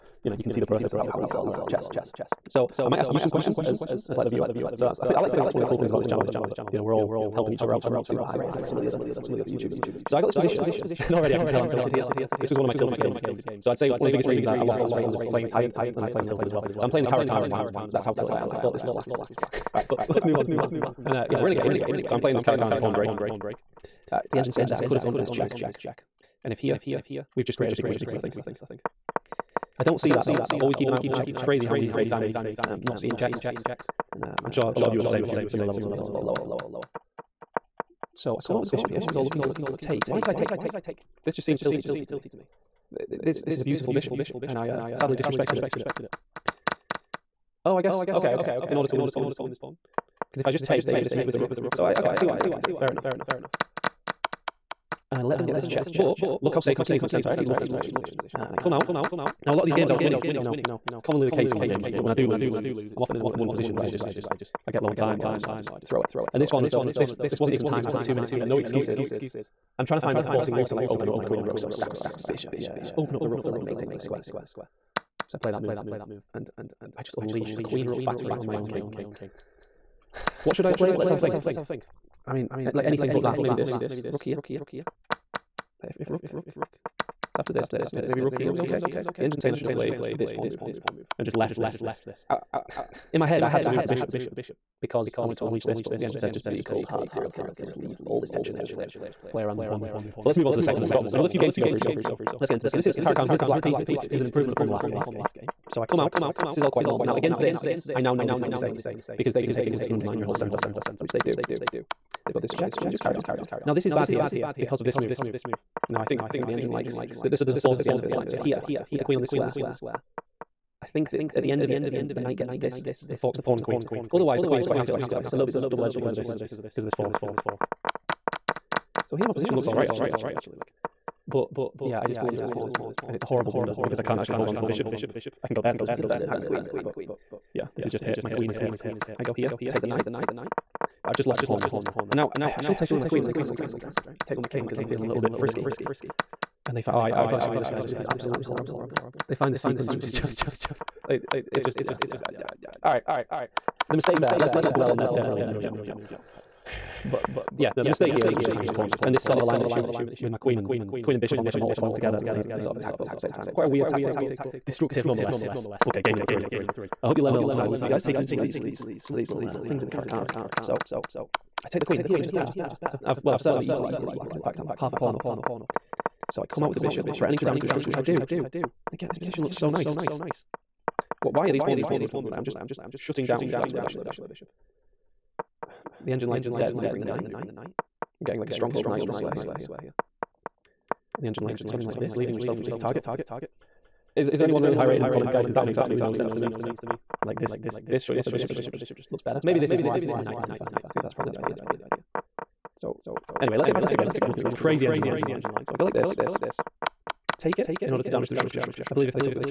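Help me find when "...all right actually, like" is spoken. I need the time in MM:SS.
02:09.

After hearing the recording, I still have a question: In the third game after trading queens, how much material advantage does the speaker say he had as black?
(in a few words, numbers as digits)
half a pawn.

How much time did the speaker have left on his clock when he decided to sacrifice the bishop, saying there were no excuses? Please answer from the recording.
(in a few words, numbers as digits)
2 minutes.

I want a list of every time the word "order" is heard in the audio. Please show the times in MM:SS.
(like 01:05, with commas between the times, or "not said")
00:48, 03:27.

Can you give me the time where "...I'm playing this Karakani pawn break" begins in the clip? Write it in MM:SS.
00:22.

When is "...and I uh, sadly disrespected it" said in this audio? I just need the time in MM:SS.
00:44.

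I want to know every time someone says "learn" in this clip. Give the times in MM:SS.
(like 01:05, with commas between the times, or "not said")
00:01, 02:47.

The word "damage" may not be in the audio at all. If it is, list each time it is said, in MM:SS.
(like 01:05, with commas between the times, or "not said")
02:57, 03:28.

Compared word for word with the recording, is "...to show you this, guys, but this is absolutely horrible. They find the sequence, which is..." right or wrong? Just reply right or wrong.
right.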